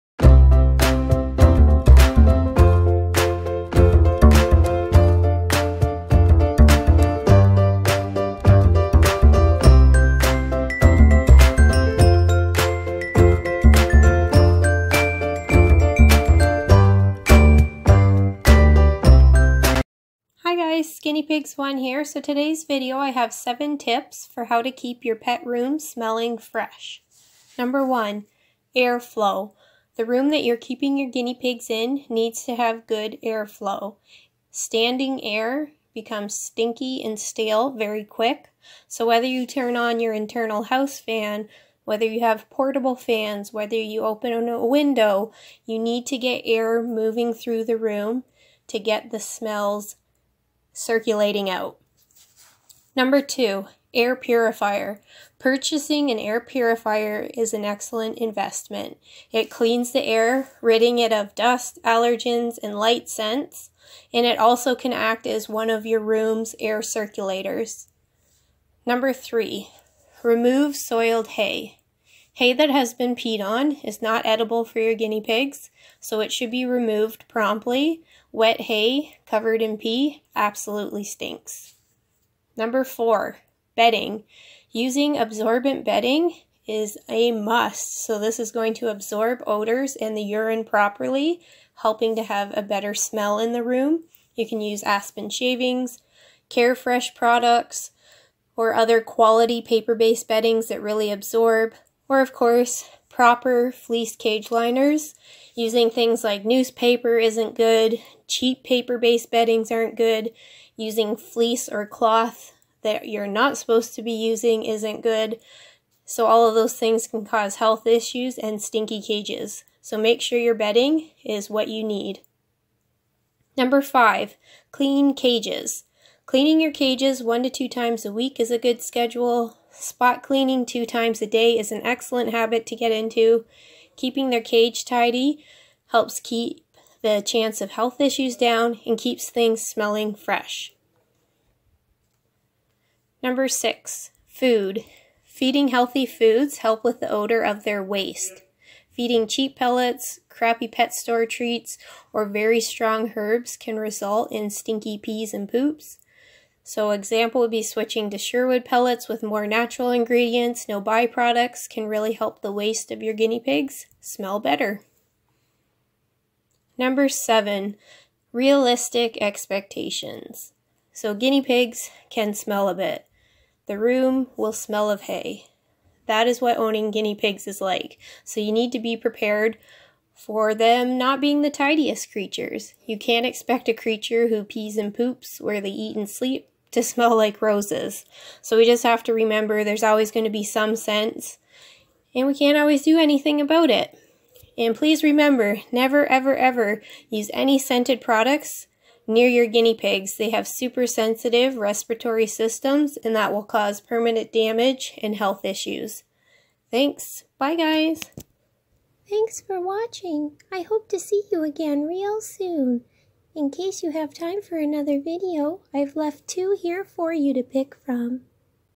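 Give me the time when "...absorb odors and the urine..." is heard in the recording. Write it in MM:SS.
01:28.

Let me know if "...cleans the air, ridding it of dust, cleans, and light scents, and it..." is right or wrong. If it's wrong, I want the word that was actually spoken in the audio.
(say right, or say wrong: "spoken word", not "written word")
wrong: "allergens", not "cleans".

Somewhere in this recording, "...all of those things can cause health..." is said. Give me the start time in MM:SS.
01:56.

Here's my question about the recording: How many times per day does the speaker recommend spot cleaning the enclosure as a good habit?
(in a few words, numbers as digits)
2.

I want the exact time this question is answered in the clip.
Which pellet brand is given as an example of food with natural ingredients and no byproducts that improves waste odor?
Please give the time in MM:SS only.
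02:38.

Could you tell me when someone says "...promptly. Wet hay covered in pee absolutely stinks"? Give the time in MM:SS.
01:17.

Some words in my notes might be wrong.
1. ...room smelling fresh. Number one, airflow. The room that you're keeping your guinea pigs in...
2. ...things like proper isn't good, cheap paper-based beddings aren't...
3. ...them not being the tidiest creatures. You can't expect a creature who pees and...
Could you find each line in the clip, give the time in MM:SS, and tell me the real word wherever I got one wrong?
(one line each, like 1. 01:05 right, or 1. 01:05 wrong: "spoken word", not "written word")
1. 00:25 right
2. 01:45 wrong: "newspaper", not "proper"
3. 03:00 right.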